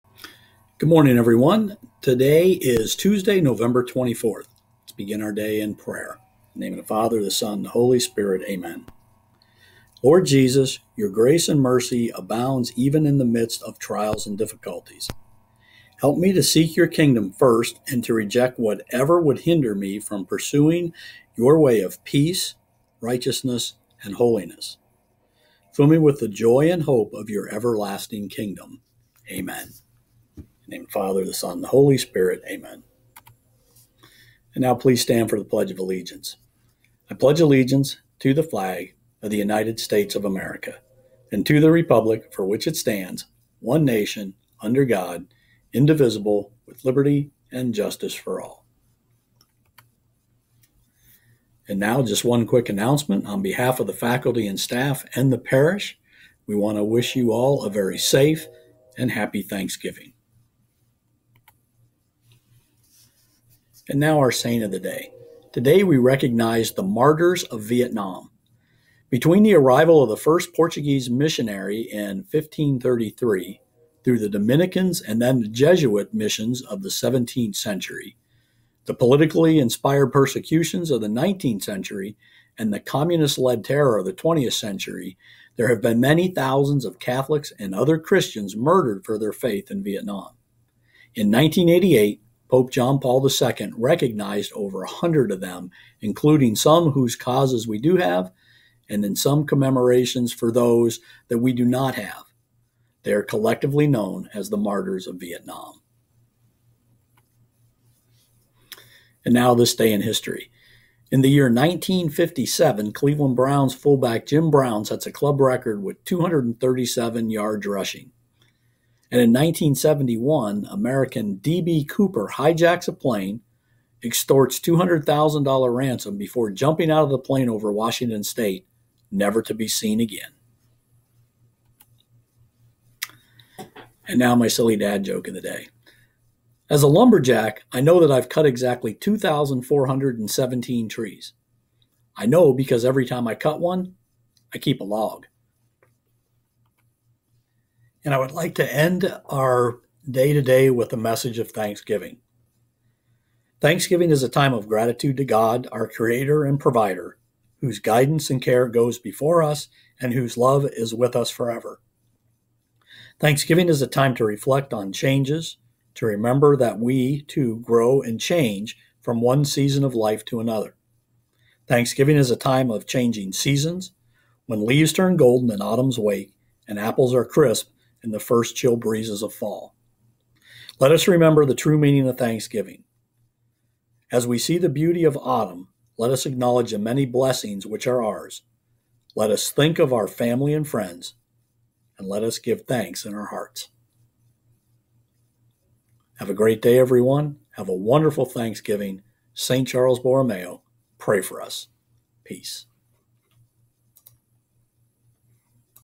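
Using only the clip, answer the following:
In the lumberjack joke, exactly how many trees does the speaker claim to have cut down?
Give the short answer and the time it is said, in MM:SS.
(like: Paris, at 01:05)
2,417, at 02:18.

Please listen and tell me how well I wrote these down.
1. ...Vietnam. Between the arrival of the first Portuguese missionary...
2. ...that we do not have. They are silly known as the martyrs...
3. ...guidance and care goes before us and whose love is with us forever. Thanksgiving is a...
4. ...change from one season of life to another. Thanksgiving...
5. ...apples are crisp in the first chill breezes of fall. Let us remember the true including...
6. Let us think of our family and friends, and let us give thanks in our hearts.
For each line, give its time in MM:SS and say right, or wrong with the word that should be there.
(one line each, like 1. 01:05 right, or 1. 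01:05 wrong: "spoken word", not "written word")
1. 01:07 right
2. 01:41 wrong: "collectively", not "silly"
3. 02:37 right
4. 02:48 right
5. 02:56 wrong: "meaning", not "including"
6. 03:09 right.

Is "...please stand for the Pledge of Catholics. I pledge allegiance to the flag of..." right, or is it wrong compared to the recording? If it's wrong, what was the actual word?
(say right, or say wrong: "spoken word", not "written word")
wrong: "Allegiance", not "Catholics".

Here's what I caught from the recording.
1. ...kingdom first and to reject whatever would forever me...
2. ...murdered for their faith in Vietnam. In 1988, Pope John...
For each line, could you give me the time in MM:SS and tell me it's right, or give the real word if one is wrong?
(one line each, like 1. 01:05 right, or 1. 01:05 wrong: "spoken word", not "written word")
1. 00:16 wrong: "hinder", not "forever"
2. 01:28 right.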